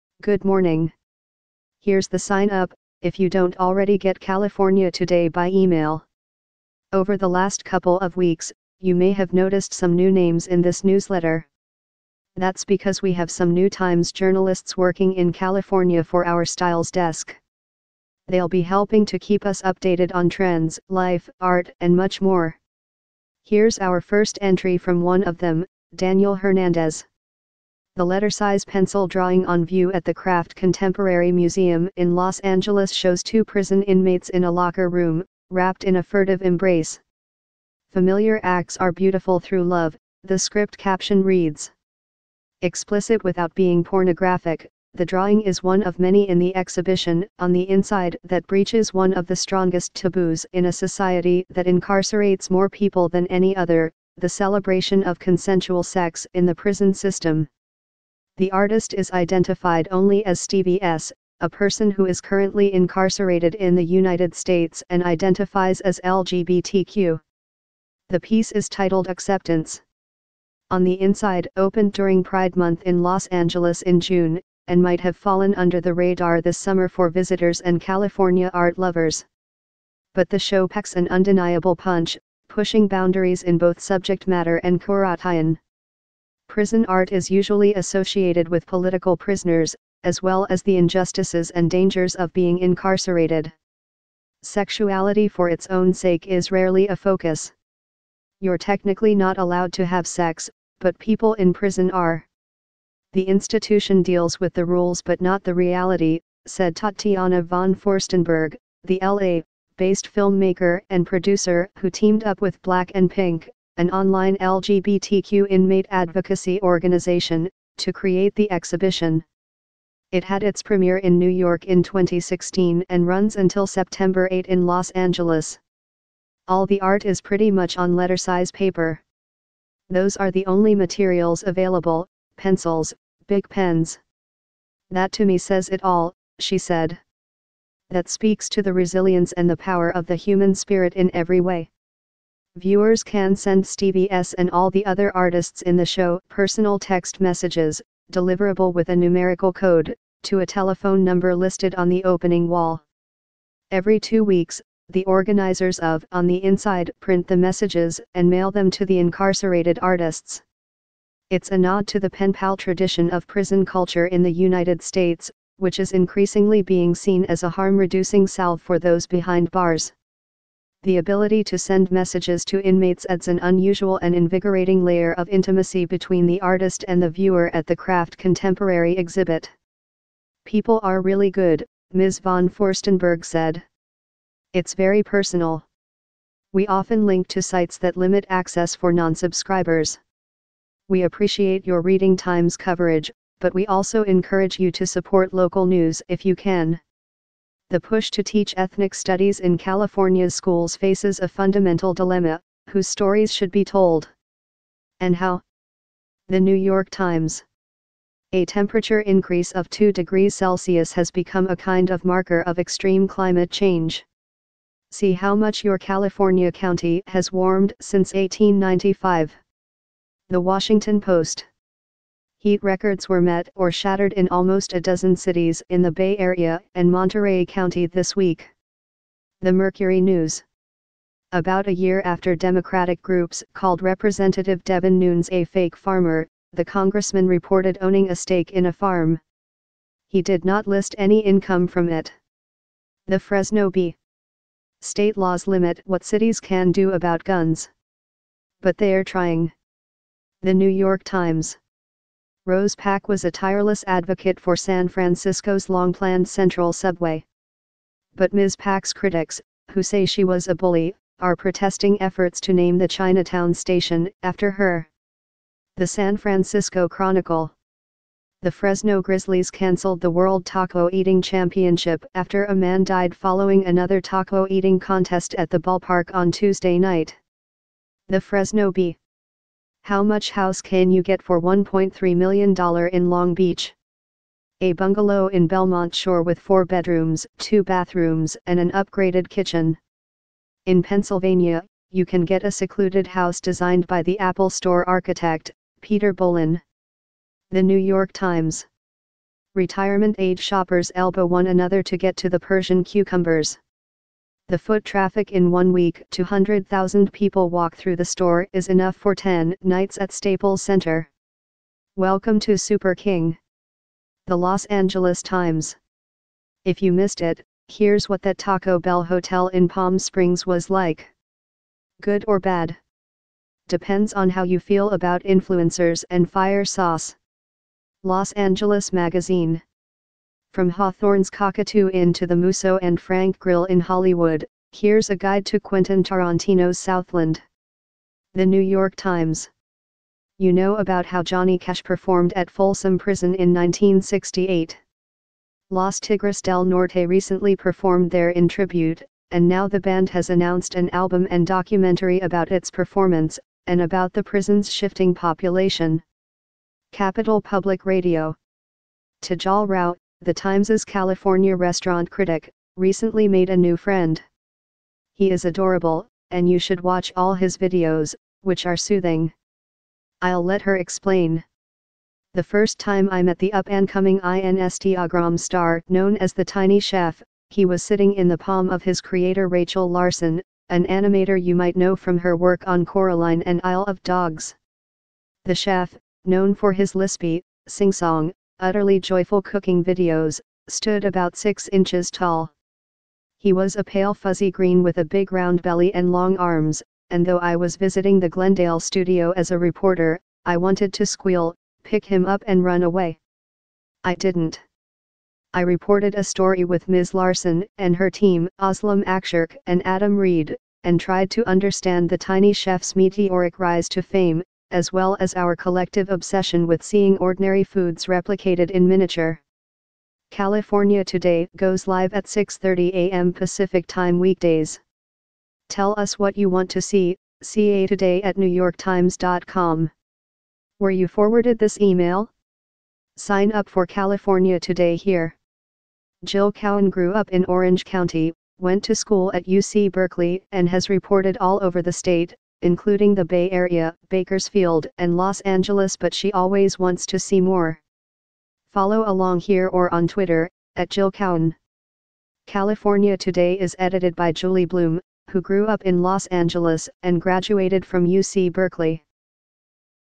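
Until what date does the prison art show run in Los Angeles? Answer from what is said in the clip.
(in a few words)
September 8.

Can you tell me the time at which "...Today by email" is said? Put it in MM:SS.
00:04.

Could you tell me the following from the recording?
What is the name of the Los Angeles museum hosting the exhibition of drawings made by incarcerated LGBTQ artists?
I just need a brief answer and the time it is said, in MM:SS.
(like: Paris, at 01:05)
Craft Contemporary Museum, at 00:30.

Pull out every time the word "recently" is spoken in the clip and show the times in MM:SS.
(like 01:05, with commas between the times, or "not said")
05:47, 06:02.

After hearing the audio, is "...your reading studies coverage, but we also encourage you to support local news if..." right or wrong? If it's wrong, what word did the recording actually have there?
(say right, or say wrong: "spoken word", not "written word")
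wrong: "times", not "studies".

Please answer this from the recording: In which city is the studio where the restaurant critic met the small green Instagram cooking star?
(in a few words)
Glendale.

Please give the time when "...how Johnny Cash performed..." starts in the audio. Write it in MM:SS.
05:41.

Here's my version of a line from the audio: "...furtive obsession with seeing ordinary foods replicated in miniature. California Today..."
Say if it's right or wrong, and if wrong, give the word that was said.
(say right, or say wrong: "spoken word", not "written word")
wrong: "collective", not "furtive".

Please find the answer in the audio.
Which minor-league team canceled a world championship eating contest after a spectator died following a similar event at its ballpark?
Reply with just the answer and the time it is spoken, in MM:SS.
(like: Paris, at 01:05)
Fresno Grizzlies, at 04:28.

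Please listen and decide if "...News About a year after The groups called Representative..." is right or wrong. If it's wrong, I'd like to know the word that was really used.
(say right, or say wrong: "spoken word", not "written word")
wrong: "Democratic", not "The".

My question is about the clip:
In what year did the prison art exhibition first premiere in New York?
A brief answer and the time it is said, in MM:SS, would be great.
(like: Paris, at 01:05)
2016, at 02:01.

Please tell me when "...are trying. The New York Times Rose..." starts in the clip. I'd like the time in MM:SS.
04:08.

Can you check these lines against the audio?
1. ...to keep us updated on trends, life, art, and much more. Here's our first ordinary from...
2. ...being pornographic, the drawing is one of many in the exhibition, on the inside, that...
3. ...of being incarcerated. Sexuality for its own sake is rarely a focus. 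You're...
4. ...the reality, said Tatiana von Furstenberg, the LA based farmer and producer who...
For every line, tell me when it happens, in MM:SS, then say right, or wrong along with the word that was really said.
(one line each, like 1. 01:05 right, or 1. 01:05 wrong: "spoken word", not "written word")
1. 00:19 wrong: "entry", not "ordinary"
2. 00:43 right
3. 01:32 right
4. 01:45 wrong: "filmmaker", not "farmer".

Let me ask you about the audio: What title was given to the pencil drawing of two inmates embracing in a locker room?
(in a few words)
Acceptance.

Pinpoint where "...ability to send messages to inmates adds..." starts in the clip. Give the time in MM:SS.
02:50.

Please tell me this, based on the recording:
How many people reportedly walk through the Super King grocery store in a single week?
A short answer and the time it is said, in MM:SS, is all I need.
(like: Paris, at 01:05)
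200,000, at 05:06.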